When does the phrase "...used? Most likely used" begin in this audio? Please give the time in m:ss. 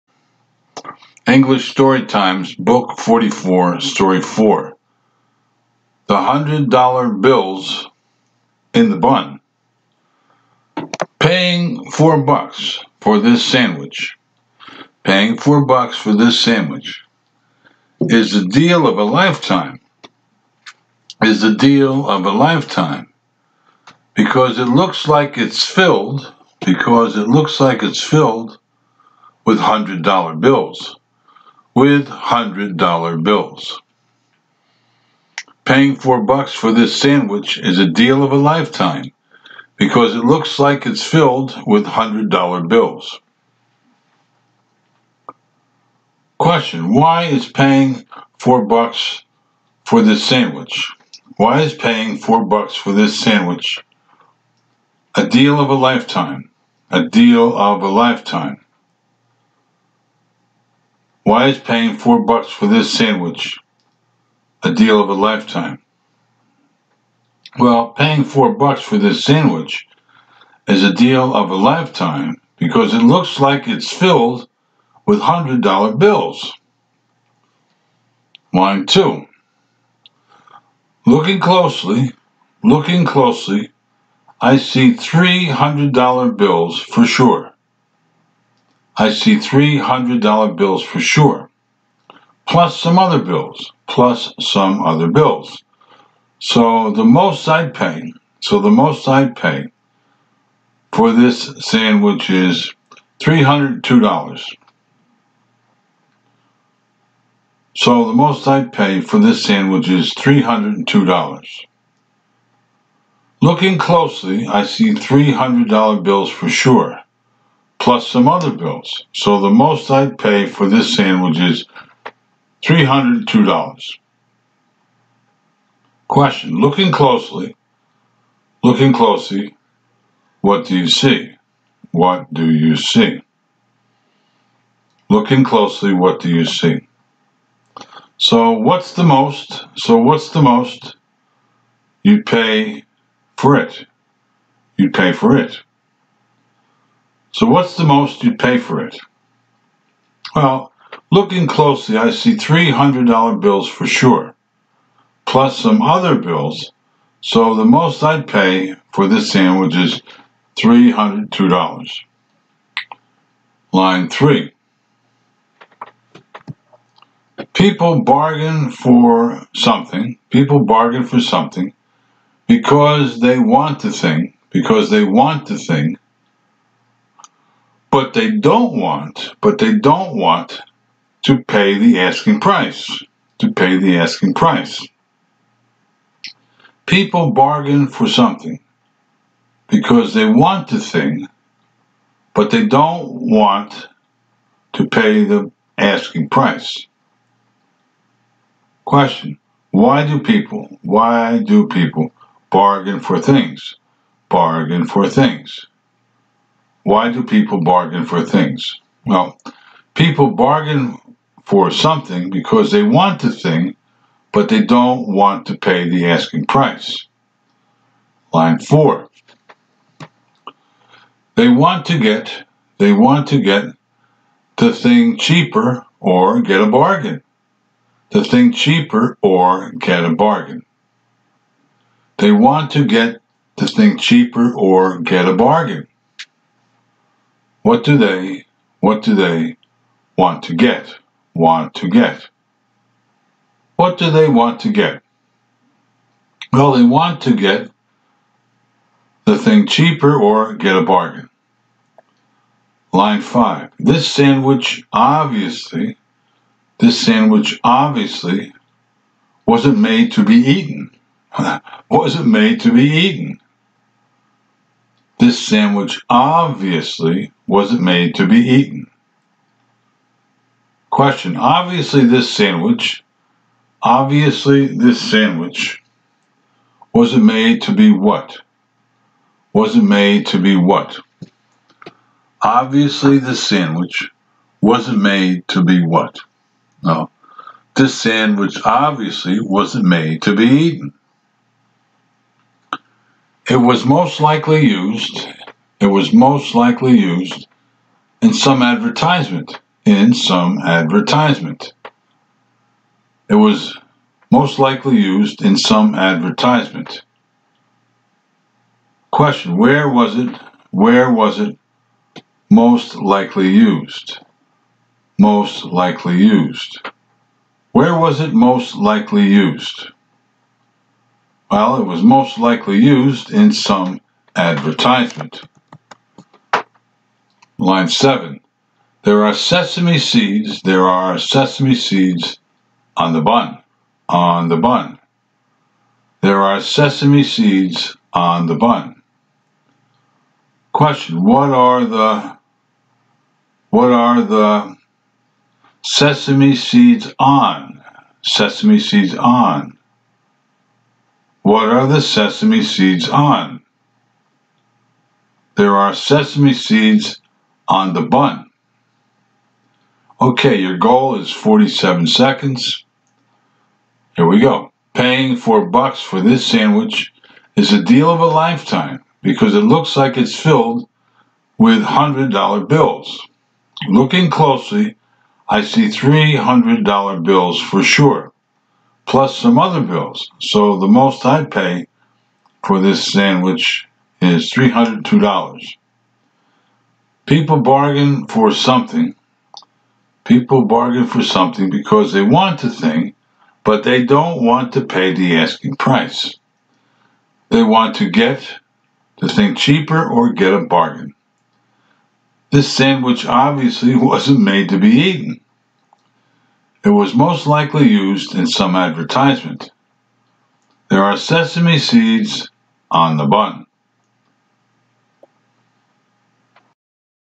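5:13.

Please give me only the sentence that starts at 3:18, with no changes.
Question Why do people, why do people bargain for things?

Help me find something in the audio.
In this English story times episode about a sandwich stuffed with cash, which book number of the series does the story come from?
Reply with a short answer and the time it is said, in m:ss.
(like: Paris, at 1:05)
44, at 0:02.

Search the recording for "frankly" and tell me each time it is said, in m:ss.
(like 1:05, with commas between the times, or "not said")
not said.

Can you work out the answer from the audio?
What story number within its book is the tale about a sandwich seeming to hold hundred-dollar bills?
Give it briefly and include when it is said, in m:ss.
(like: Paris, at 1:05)
4, at 0:03.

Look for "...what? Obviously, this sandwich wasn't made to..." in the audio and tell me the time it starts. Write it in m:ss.
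4:40.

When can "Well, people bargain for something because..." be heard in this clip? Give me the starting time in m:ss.
3:29.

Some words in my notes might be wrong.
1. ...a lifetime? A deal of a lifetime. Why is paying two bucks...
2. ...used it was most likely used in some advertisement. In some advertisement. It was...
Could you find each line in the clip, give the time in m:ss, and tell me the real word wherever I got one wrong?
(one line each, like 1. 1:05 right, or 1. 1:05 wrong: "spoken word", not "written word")
1. 0:55 wrong: "four", not "two"
2. 4:54 right.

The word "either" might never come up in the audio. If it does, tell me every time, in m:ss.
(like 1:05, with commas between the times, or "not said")
not said.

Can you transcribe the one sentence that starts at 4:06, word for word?
Well, they want to get the thing cheaper or get a bargain.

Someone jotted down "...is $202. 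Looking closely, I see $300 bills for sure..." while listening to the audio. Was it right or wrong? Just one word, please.
wrong.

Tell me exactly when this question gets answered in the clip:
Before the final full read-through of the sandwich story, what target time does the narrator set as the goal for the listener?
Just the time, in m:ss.
6:01.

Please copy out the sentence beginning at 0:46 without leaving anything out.
Question, why is paying four bucks for this sandwich?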